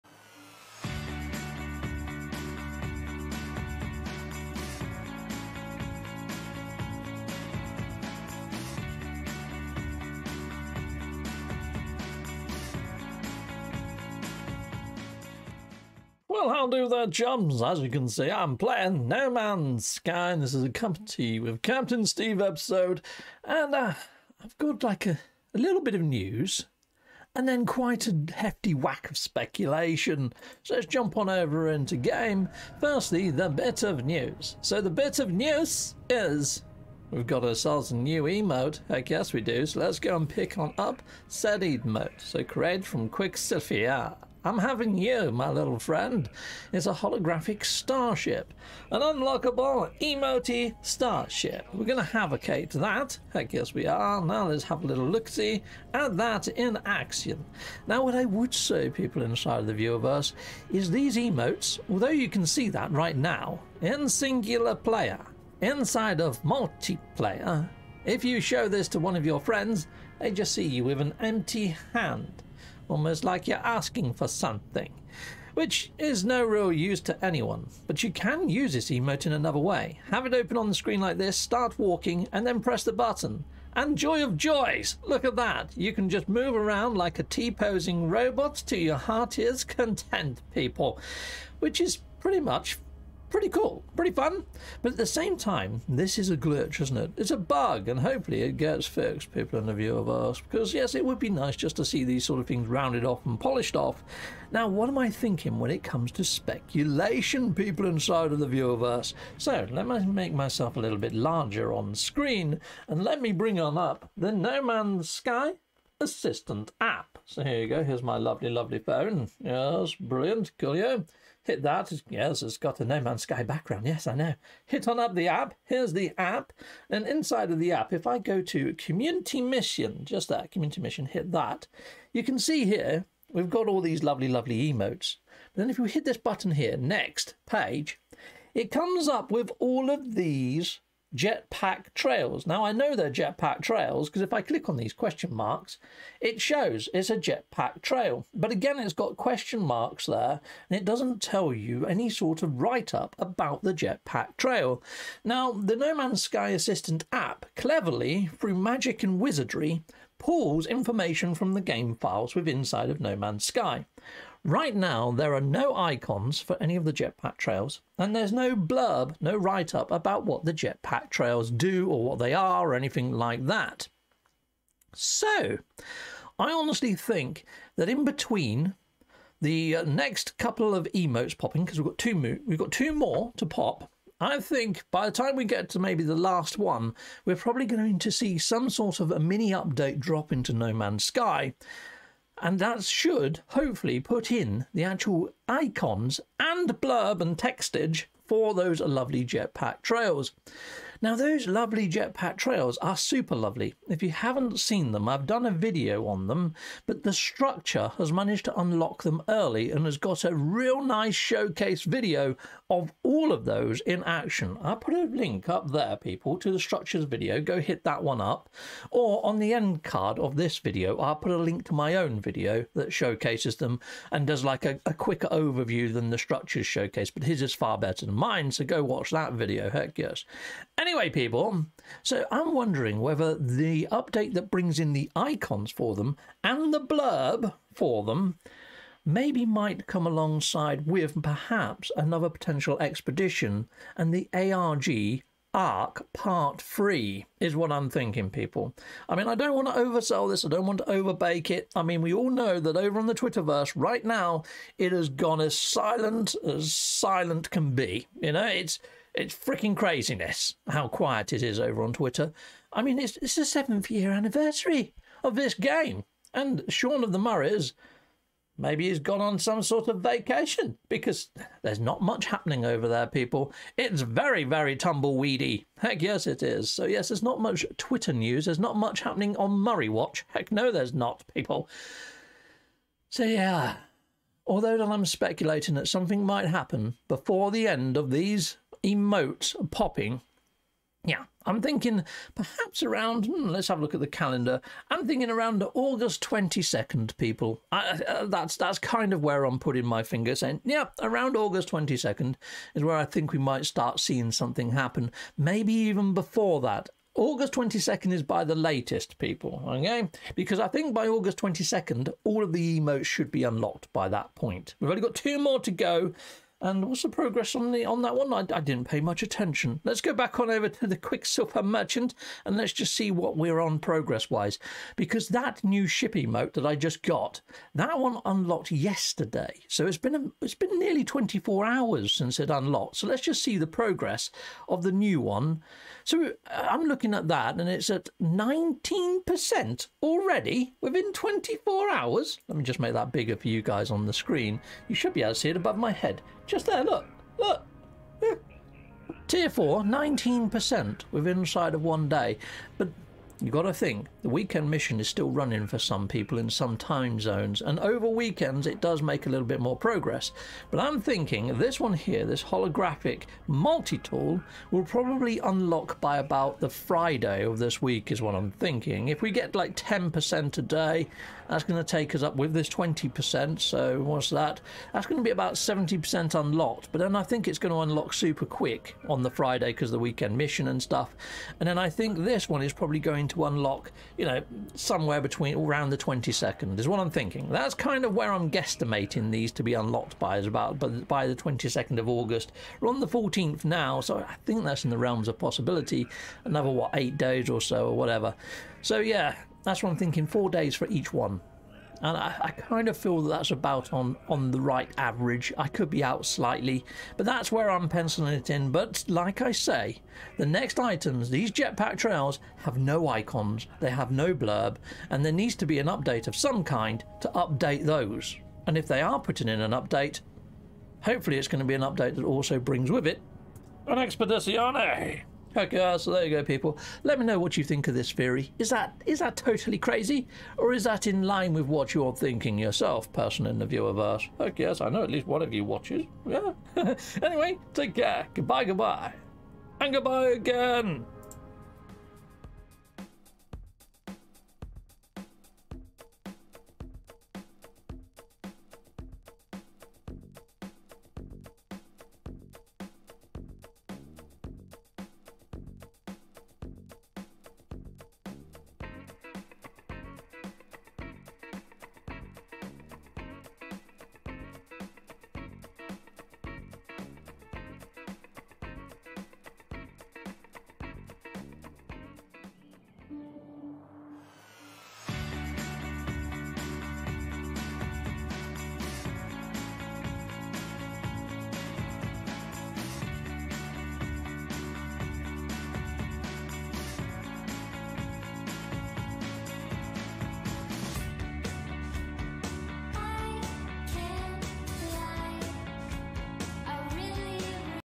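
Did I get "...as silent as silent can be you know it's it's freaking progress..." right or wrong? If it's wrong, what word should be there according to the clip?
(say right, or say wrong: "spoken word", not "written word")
wrong: "craziness", not "progress".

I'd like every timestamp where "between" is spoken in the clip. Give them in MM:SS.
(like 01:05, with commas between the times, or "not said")
02:58, 06:25.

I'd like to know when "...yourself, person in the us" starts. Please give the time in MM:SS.
07:12.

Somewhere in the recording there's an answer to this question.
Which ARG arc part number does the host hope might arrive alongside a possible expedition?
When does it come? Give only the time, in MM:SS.
04:06.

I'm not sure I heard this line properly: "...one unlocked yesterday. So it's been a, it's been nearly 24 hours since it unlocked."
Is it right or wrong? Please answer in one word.
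right.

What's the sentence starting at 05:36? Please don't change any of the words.
So uh, I'm looking at that and it's at 19% already within 24 hours.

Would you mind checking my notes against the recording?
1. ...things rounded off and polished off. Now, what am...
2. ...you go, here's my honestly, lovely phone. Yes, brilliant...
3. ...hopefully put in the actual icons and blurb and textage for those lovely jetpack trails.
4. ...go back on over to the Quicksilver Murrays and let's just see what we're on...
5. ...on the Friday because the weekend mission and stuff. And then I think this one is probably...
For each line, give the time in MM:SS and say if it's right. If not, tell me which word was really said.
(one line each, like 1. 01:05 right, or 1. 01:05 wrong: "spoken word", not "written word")
1. 01:42 right
2. 01:57 wrong: "lovely", not "honestly"
3. 03:13 right
4. 05:20 wrong: "Merchant", not "Murrays"
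5. 06:19 right.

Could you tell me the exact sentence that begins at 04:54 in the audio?
I'm thinking around August 22nd, people.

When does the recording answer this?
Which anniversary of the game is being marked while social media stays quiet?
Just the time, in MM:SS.
04:23.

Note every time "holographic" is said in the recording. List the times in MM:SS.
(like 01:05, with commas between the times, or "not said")
00:46, 06:02.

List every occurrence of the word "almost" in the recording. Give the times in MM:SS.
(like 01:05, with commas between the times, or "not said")
01:12.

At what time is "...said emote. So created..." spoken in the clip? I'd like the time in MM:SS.
00:41.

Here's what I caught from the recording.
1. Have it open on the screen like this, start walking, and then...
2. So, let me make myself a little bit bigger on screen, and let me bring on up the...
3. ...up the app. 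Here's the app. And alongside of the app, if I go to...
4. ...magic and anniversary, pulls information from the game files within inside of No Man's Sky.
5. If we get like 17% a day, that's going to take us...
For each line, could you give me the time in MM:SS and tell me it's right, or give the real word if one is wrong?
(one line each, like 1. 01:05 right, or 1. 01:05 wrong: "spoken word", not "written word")
1. 01:20 right
2. 01:49 wrong: "larger", not "bigger"
3. 02:04 wrong: "inside", not "alongside"
4. 02:38 wrong: "wizardry", not "anniversary"
5. 06:09 wrong: "10", not "17".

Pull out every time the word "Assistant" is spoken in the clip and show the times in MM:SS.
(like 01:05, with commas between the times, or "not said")
01:56, 02:36.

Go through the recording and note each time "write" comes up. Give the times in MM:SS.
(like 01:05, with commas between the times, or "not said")
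02:32, 02:49.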